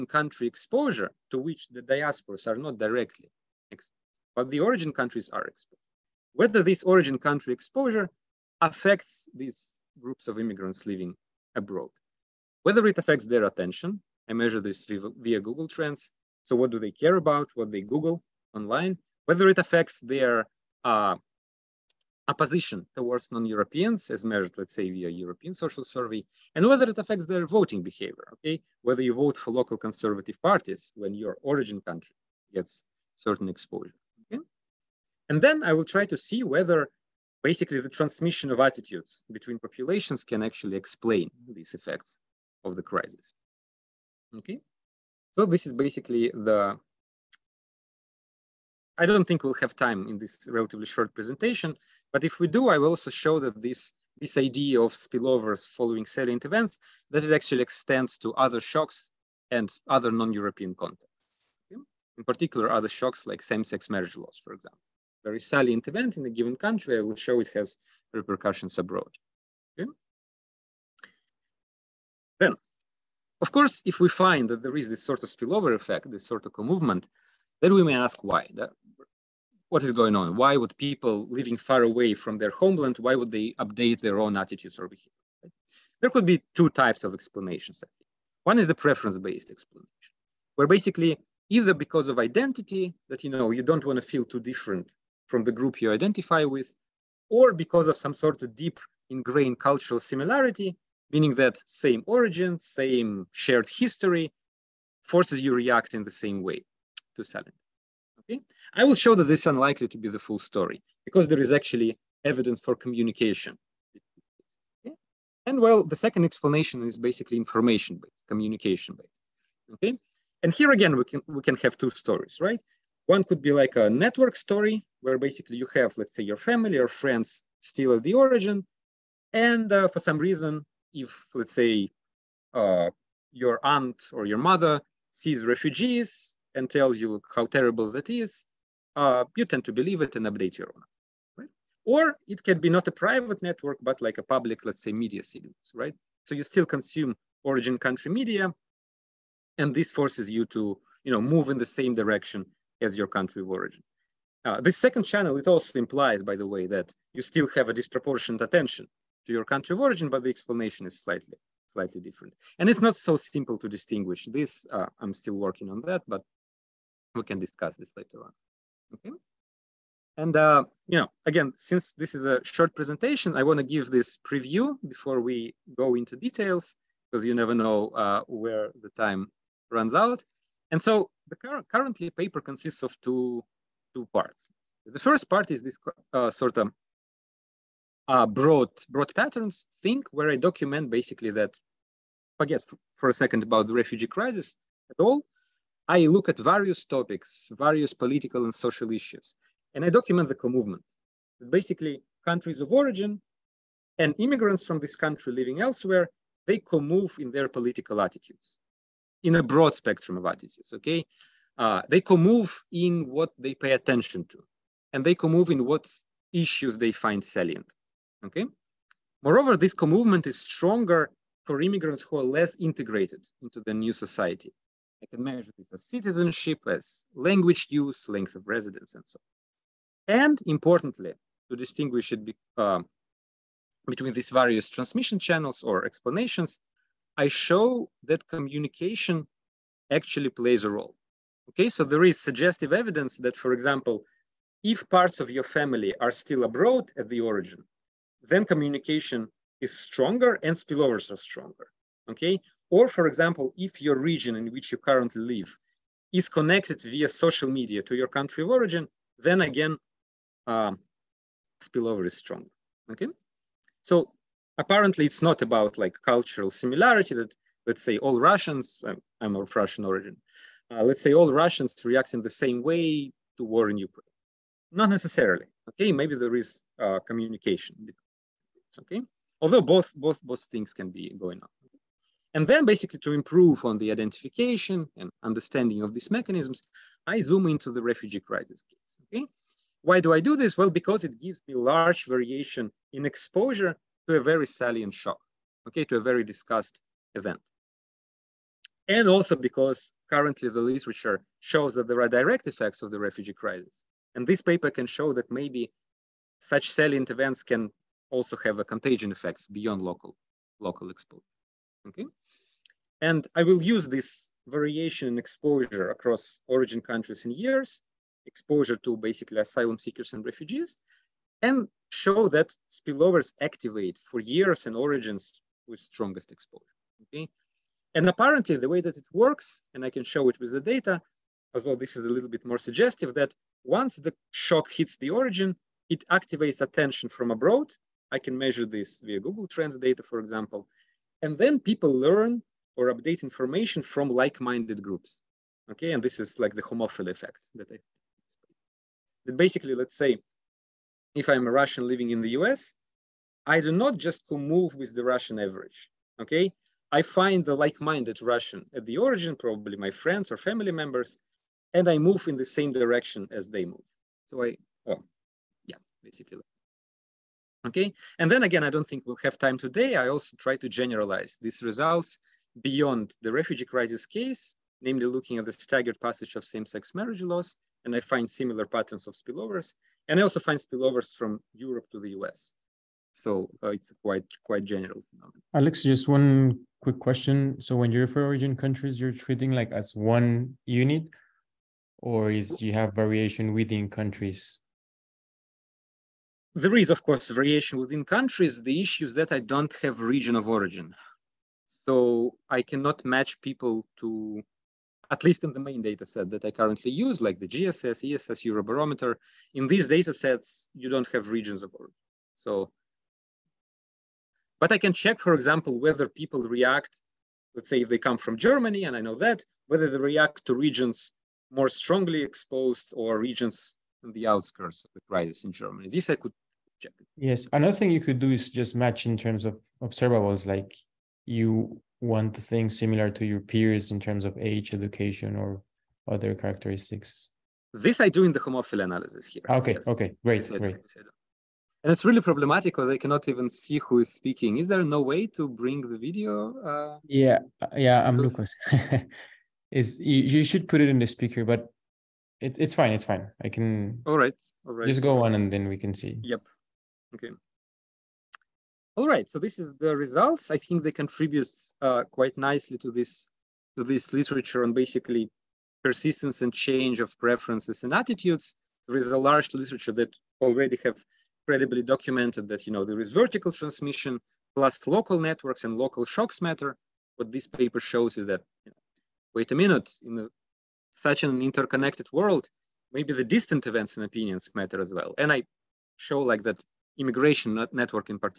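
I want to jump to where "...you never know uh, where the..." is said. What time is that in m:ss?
2:57.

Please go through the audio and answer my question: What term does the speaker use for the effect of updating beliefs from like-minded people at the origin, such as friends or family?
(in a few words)
Homophily effect.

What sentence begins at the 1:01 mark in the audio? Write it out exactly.
In particular, other shocks like same-sex marriage laws, for example.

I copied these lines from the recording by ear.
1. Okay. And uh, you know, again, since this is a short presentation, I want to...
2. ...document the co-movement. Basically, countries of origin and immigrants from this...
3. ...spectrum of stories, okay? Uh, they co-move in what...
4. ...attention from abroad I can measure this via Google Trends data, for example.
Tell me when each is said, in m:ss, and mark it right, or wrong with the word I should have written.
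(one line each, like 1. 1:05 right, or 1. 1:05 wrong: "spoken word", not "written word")
1. 2:48 right
2. 3:19 right
3. 3:29 wrong: "attitudes", not "stories"
4. 5:36 right.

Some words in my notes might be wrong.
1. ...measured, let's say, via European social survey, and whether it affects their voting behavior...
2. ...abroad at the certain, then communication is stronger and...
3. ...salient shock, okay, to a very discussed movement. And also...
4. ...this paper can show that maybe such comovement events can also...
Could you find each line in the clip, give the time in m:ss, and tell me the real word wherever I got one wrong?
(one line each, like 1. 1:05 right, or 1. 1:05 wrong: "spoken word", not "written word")
1. 0:24 right
2. 4:06 wrong: "origin", not "certain"
3. 4:54 wrong: "event", not "movement"
4. 5:04 wrong: "salient", not "comovement".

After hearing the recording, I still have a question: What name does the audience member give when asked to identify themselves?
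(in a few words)
Lucas.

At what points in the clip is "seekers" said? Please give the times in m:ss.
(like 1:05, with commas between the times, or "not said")
5:19.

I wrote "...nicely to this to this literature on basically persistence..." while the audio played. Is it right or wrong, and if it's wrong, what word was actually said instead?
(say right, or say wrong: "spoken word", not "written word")
right.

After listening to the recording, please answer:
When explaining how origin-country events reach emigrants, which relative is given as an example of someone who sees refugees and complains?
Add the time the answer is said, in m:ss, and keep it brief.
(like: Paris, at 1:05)
Aunt, at 2:13.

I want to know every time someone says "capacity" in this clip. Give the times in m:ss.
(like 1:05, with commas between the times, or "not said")
not said.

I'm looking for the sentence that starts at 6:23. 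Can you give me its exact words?
So uh, it's quite quite general phenomenon.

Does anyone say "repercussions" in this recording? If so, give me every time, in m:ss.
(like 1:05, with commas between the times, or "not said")
1:08.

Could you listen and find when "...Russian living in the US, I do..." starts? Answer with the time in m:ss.
5:51.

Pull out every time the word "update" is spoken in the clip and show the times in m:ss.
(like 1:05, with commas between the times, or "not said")
1:23, 2:20, 5:42.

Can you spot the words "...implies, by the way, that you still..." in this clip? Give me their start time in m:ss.
2:35.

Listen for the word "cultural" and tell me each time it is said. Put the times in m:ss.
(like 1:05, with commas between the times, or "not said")
1:39, 4:26.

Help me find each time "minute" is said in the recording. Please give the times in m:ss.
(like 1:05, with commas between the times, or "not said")
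7:59.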